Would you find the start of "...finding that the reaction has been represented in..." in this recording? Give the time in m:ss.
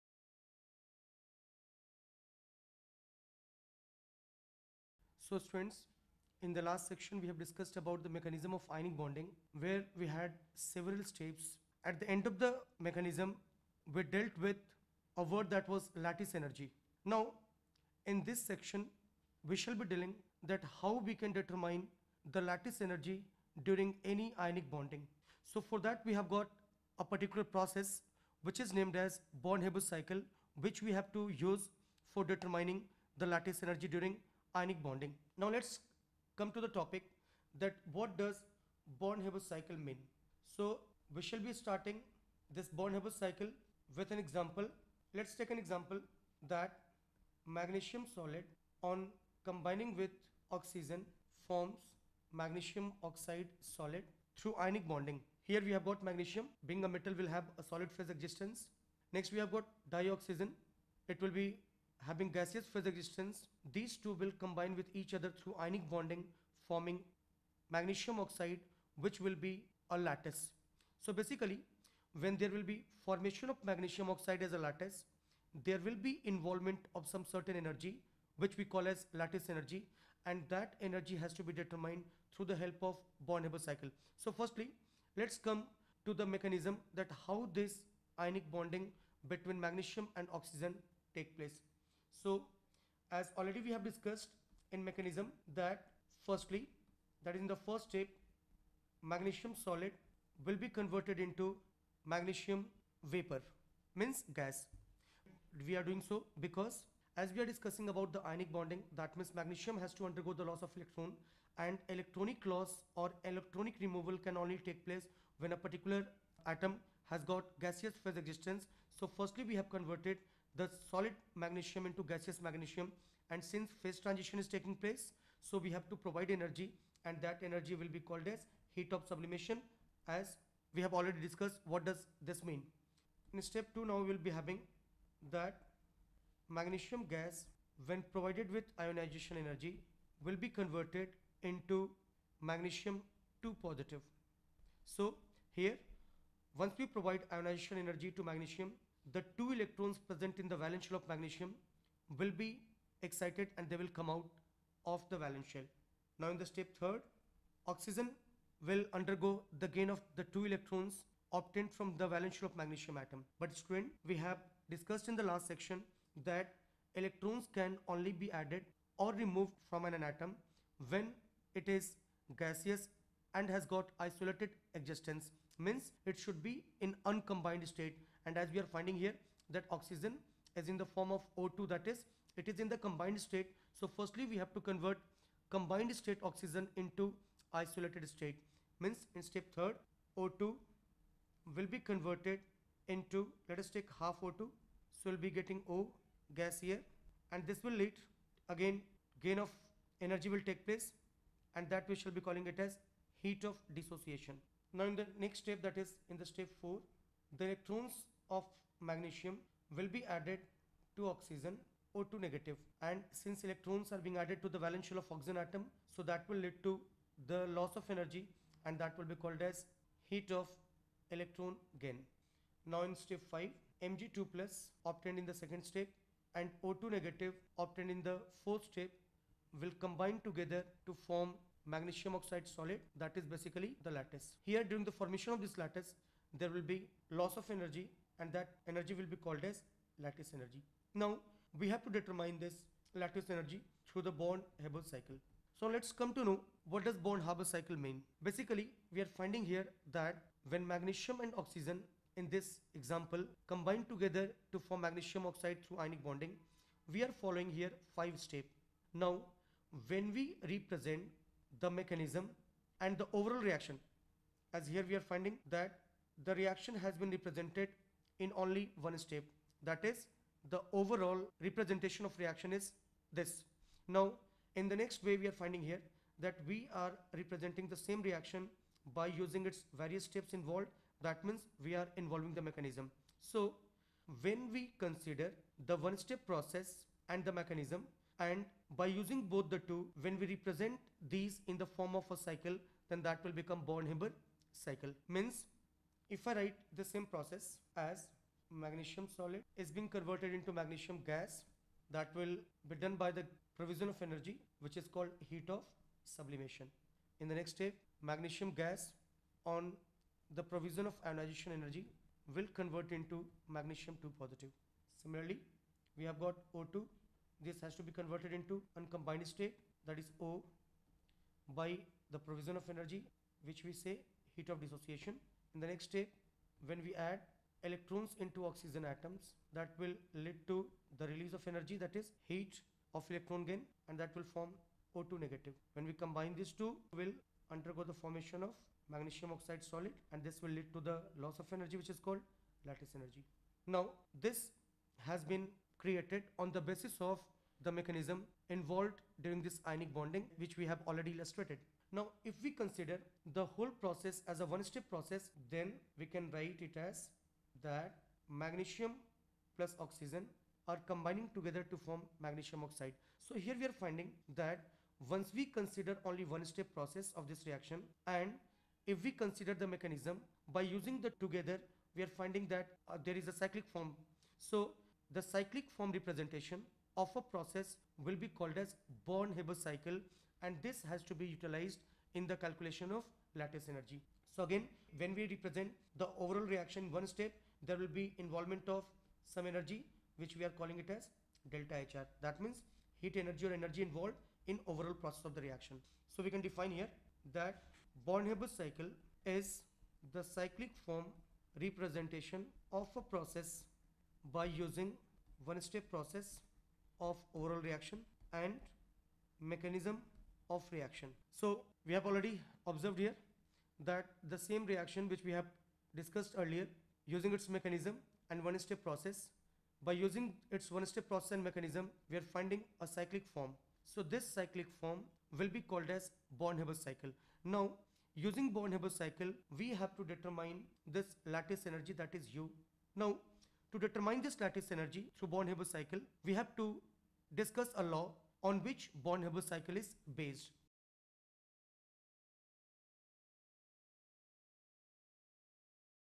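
4:25.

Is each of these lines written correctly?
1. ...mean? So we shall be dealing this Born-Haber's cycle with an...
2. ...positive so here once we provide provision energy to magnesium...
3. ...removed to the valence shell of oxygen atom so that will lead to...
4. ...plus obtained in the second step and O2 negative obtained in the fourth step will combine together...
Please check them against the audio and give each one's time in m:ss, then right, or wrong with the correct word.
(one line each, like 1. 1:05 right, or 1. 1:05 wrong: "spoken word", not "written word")
1. 0:39 wrong: "starting", not "dealing"
2. 2:23 wrong: "ionization", not "provision"
3. 3:34 wrong: "added", not "removed"
4. 3:44 right.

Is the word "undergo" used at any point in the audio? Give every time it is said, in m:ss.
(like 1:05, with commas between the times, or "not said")
1:50, 2:38, 5:37.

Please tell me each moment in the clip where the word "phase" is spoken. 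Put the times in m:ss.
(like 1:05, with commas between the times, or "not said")
0:57, 1:02, 1:58, 2:03.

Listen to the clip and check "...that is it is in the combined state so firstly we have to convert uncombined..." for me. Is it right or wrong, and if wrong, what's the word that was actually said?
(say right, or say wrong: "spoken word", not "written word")
wrong: "combined", not "uncombined".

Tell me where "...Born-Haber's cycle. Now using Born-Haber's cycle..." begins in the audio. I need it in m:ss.
7:06.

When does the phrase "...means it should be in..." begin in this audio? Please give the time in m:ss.
2:55.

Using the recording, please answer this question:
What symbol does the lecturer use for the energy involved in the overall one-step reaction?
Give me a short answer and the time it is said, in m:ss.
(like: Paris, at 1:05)
Delta HR, at 6:31.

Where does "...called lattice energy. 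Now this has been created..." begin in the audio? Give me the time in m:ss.
5:41.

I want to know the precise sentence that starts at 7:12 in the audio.
Now to determine this lattice energy through Born-Haber cycle, we have to discuss a law on which Born-Haber cycle is based.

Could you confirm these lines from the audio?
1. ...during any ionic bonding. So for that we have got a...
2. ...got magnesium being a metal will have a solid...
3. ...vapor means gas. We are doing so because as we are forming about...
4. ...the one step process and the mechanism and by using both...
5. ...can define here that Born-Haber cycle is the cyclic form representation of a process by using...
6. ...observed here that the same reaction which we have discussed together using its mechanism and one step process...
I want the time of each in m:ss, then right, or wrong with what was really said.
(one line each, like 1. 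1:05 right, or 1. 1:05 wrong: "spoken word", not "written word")
1. 0:23 right
2. 0:55 right
3. 1:43 wrong: "discussing", not "forming"
4. 4:45 right
5. 6:36 right
6. 6:52 wrong: "earlier", not "together".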